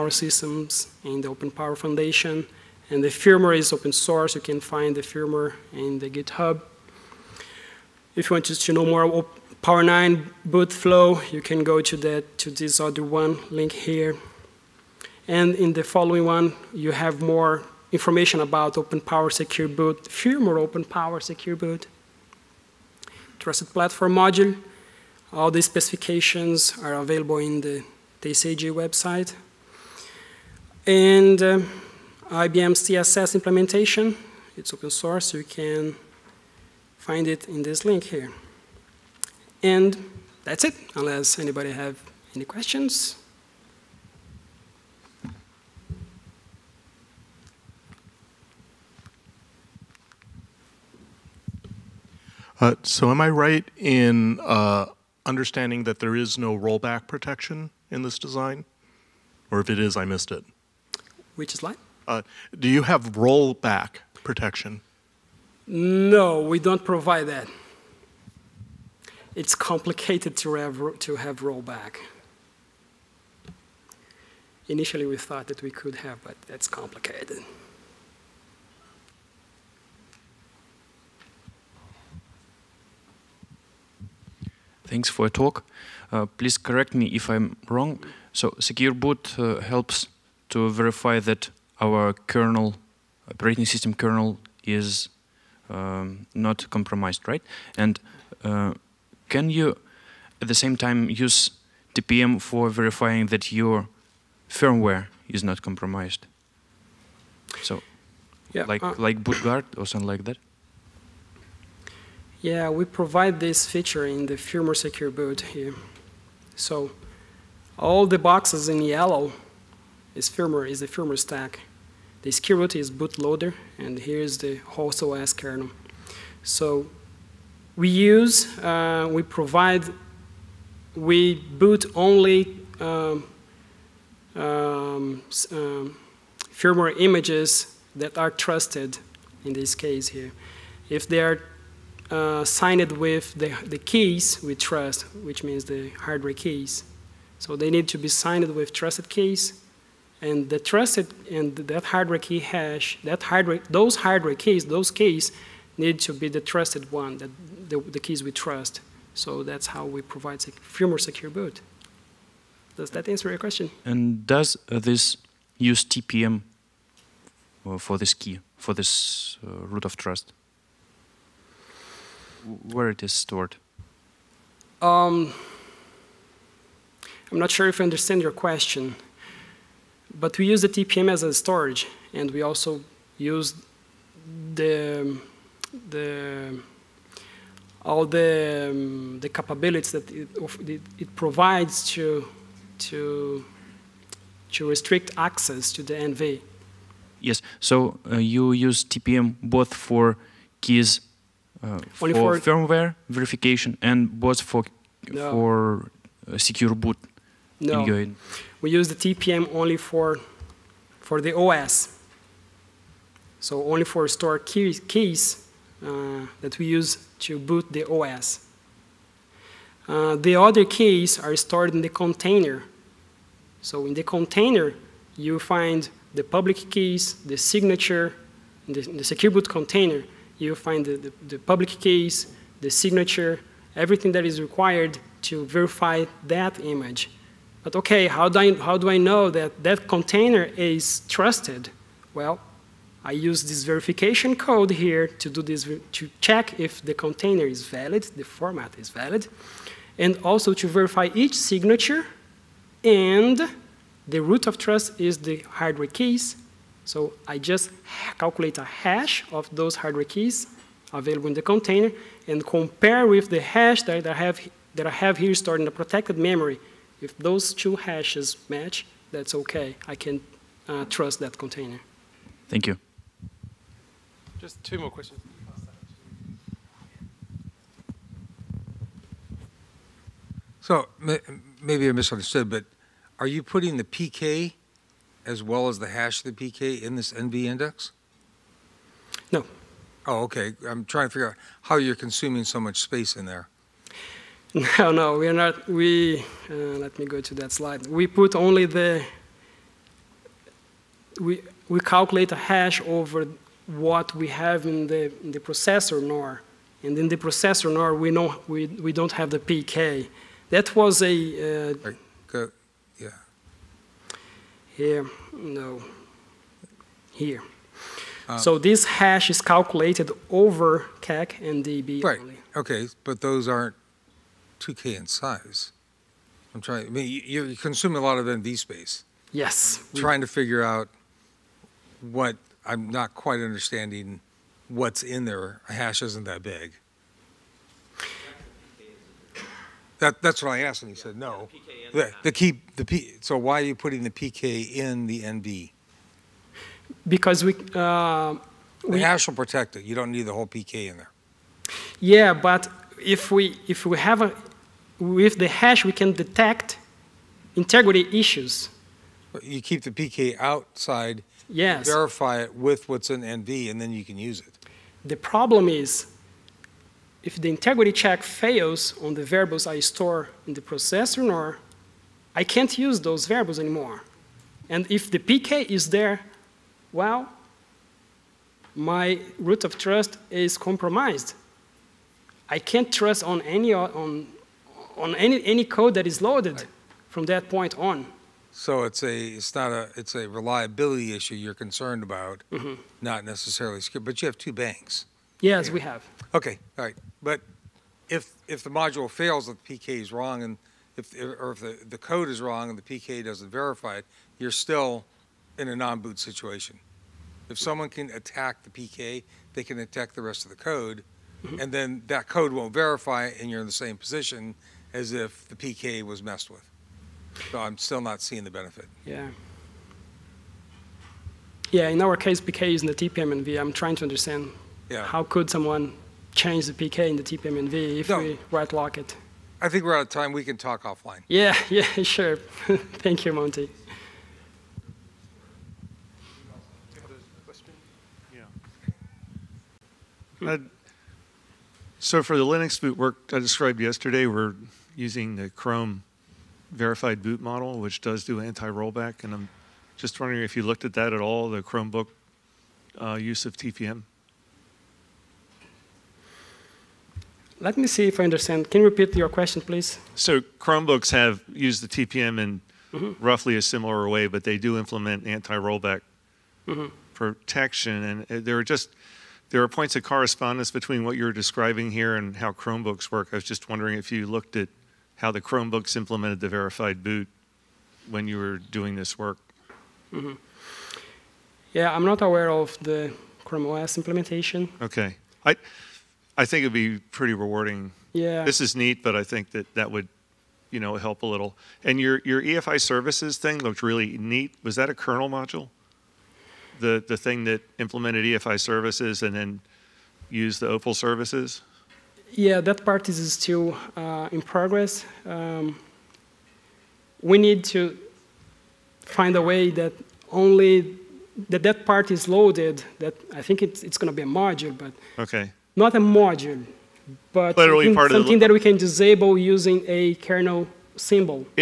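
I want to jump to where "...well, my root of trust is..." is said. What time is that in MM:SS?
06:16.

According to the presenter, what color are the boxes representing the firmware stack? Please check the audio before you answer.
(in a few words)
Yellow.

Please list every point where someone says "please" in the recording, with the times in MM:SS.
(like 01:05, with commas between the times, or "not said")
01:26, 07:39.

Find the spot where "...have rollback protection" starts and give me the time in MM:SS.
01:02.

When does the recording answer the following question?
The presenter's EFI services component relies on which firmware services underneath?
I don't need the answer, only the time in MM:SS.
08:20.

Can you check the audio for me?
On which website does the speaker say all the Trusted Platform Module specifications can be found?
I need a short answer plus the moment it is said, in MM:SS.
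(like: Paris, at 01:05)
TCG website, at 00:28.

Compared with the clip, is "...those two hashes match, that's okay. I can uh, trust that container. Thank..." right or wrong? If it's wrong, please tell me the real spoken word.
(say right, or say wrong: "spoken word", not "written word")
right.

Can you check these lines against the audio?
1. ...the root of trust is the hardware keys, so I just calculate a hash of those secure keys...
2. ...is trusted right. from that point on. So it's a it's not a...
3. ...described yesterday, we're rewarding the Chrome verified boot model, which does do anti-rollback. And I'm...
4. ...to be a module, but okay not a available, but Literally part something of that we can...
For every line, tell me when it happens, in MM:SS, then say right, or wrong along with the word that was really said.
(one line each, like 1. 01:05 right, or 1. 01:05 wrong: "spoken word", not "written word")
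1. 04:14 wrong: "hardware", not "secure"
2. 06:26 wrong: "loaded", not "trusted"
3. 07:23 wrong: "using", not "rewarding"
4. 08:34 wrong: "module", not "available".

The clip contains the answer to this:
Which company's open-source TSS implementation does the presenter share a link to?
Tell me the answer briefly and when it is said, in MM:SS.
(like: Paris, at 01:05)
IBM, at 00:32.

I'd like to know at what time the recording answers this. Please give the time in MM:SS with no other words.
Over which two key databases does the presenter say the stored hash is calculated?
05:20.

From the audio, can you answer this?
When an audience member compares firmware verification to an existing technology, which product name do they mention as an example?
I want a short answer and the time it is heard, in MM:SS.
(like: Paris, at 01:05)
Bootguard, at 01:49.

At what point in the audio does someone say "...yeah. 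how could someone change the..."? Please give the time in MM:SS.
07:04.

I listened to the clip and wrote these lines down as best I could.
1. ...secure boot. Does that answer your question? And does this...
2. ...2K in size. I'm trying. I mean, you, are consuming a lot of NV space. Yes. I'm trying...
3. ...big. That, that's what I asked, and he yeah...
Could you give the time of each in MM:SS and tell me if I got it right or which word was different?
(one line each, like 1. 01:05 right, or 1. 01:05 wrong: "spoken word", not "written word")
1. 02:40 right
2. 05:24 right
3. 05:36 right.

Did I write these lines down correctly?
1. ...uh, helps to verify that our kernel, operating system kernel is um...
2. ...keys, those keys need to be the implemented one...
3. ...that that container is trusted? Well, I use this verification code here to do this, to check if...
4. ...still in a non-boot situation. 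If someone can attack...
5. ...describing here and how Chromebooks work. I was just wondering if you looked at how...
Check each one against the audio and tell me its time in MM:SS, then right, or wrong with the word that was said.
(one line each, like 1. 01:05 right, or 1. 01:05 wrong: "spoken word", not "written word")
1. 01:29 right
2. 02:34 wrong: "trusted", not "implemented"
3. 03:59 right
4. 06:44 right
5. 07:51 right.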